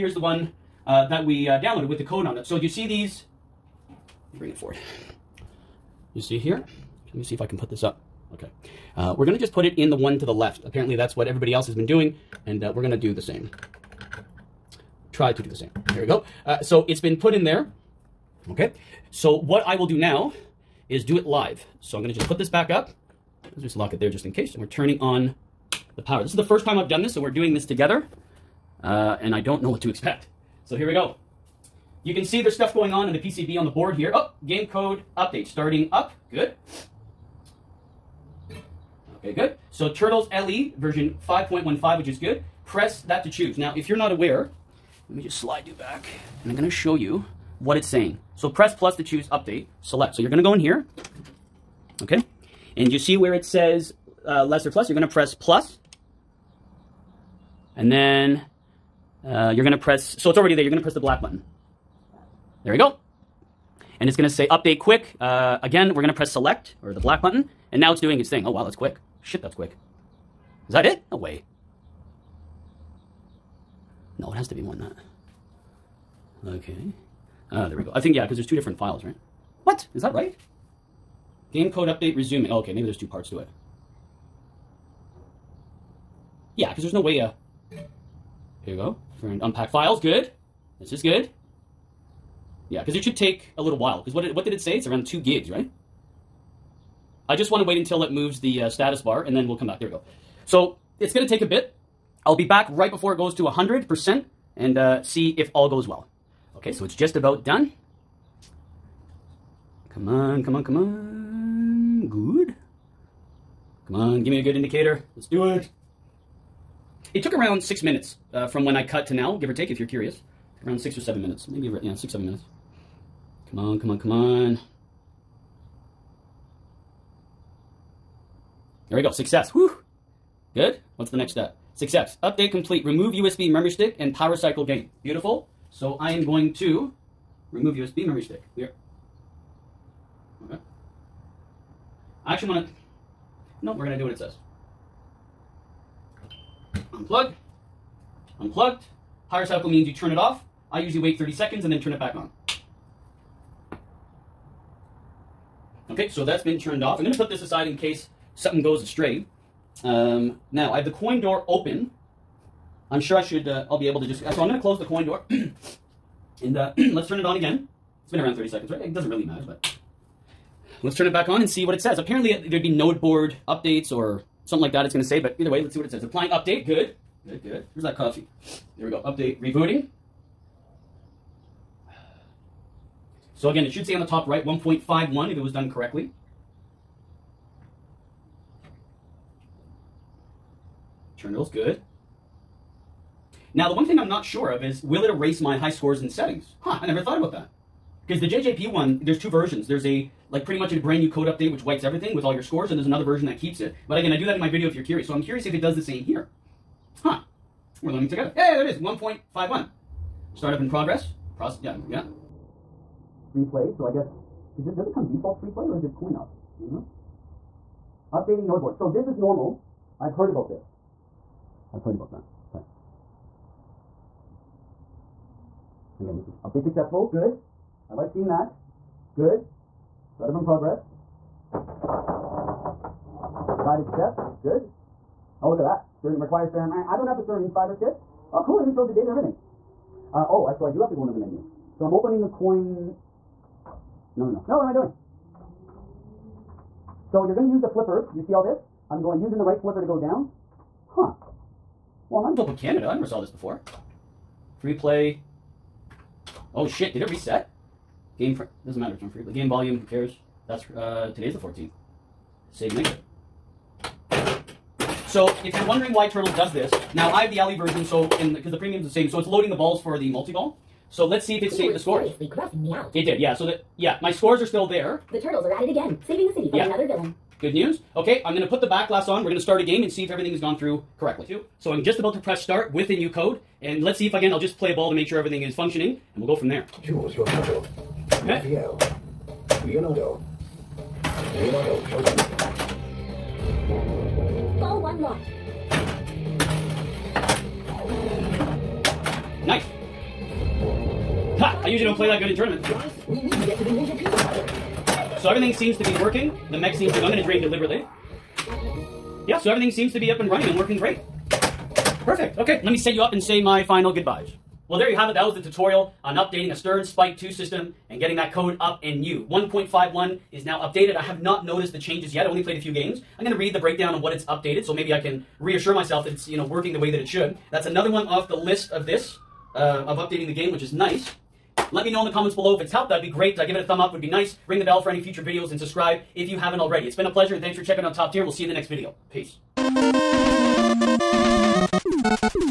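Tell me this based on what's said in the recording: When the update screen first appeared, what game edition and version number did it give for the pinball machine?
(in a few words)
Turtles LE version 5.15.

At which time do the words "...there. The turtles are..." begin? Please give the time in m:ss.
4:34.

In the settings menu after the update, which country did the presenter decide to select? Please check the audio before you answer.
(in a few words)
Canada.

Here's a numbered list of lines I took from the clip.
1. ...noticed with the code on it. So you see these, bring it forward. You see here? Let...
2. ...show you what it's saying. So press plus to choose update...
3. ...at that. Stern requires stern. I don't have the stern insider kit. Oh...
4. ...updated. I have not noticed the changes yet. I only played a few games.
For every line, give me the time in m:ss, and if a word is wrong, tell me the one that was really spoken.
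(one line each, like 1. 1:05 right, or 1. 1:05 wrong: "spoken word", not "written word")
1. 0:01 wrong: "downloaded", not "noticed"
2. 0:46 right
3. 3:55 right
4. 5:20 right.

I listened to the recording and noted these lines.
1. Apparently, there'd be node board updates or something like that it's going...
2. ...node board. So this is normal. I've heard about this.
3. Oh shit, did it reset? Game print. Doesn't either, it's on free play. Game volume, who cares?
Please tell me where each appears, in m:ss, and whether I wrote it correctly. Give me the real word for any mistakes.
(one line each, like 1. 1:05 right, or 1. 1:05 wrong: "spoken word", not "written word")
1. 2:51 right
2. 3:38 right
3. 4:16 wrong: "matter", not "either".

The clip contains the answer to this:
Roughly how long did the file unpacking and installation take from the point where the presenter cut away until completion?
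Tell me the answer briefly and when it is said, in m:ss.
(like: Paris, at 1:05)
6 or 7 minutes, at 2:00.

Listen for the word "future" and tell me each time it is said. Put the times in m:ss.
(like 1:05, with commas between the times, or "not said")
5:34.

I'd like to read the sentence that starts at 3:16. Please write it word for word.
Huh, I never thought about that.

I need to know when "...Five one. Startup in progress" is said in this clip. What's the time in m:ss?
3:29.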